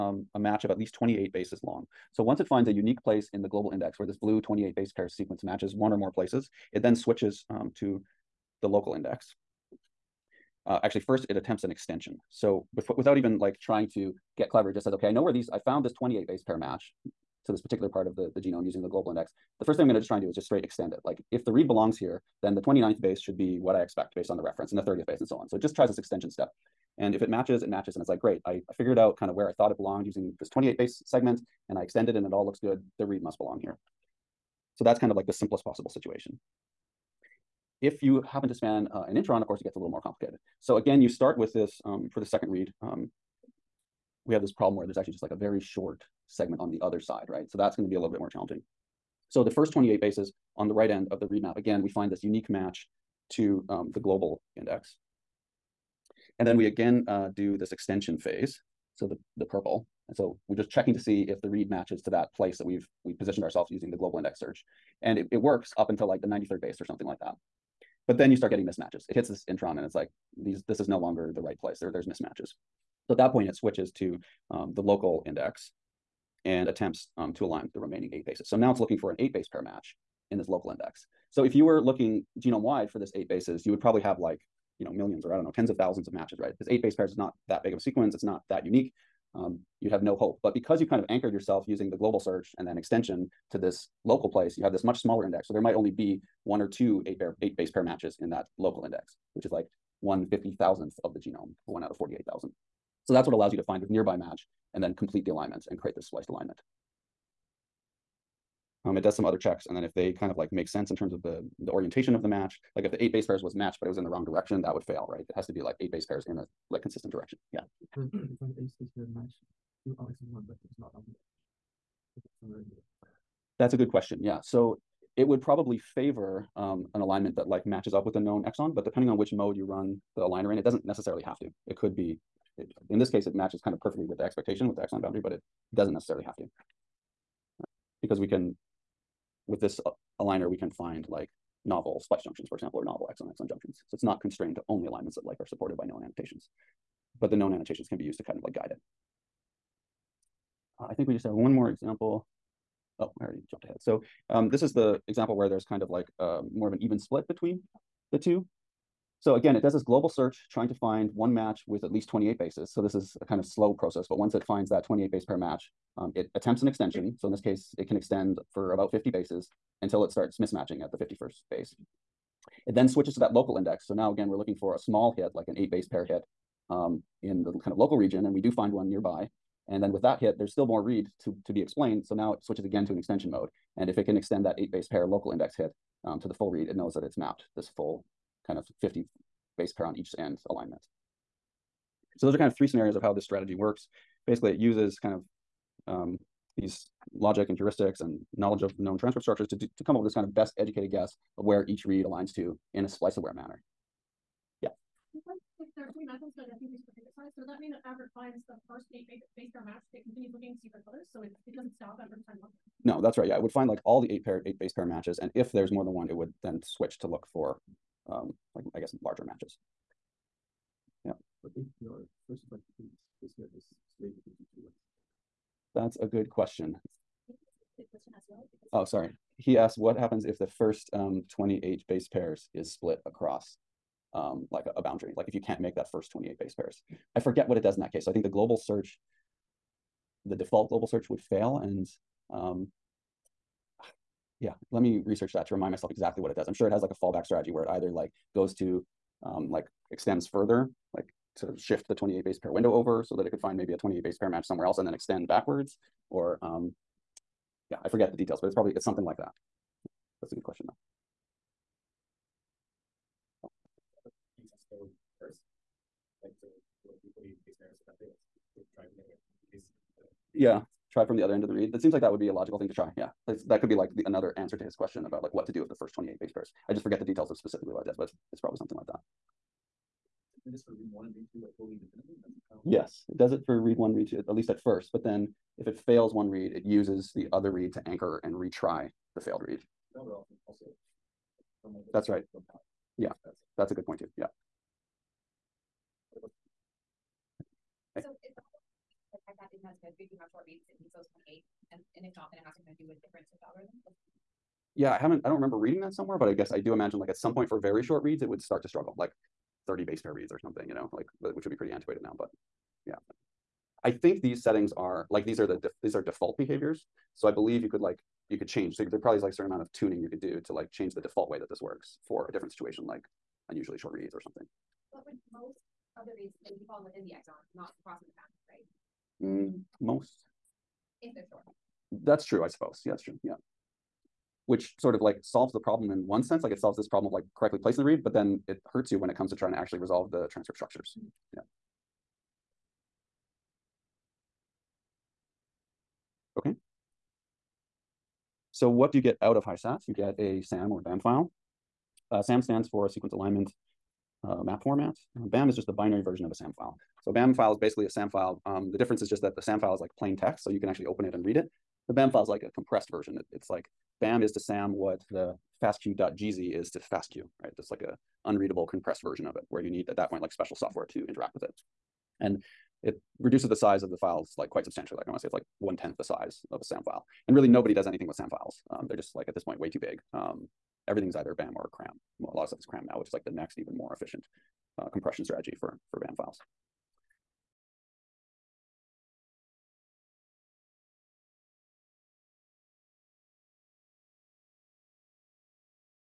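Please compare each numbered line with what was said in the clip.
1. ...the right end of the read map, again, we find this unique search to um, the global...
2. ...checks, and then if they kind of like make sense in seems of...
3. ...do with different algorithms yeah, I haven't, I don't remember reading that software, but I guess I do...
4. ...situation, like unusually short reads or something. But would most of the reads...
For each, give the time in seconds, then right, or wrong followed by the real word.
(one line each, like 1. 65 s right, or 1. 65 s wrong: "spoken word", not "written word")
1. 50 s wrong: "match", not "search"
2. 109 s wrong: "terms", not "seems"
3. 302 s wrong: "somewhere", not "software"
4. 322 s right.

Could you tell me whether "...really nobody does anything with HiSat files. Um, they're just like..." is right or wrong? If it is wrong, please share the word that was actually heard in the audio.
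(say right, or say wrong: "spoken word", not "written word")
wrong: "SAM", not "HiSat".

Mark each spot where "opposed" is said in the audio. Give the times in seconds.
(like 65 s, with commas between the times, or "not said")
not said.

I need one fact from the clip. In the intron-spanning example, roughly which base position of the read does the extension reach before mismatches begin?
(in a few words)
93rd base.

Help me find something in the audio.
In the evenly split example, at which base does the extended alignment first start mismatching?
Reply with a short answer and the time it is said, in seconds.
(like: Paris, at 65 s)
51st base, at 170 s.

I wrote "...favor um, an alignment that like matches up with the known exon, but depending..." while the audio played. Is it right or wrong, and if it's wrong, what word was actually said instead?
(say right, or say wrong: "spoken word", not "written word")
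right.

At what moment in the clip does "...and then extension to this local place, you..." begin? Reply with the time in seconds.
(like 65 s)
92 s.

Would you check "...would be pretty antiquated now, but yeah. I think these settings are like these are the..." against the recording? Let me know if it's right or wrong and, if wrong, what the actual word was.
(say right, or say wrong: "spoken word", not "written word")
right.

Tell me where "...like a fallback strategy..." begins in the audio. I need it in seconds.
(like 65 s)
246 s.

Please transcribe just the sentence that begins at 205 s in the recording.
are three methods that I think we should size?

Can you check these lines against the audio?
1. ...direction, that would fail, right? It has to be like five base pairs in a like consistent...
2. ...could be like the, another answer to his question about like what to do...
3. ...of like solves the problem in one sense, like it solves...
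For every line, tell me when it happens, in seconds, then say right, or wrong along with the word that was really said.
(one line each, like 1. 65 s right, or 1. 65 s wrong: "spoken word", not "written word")
1. 114 s wrong: "eight", not "five"
2. 273 s right
3. 334 s right.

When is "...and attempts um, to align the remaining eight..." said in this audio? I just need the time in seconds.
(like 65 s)
76 s.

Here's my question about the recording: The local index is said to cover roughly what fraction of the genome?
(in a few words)
one fifty thousandth.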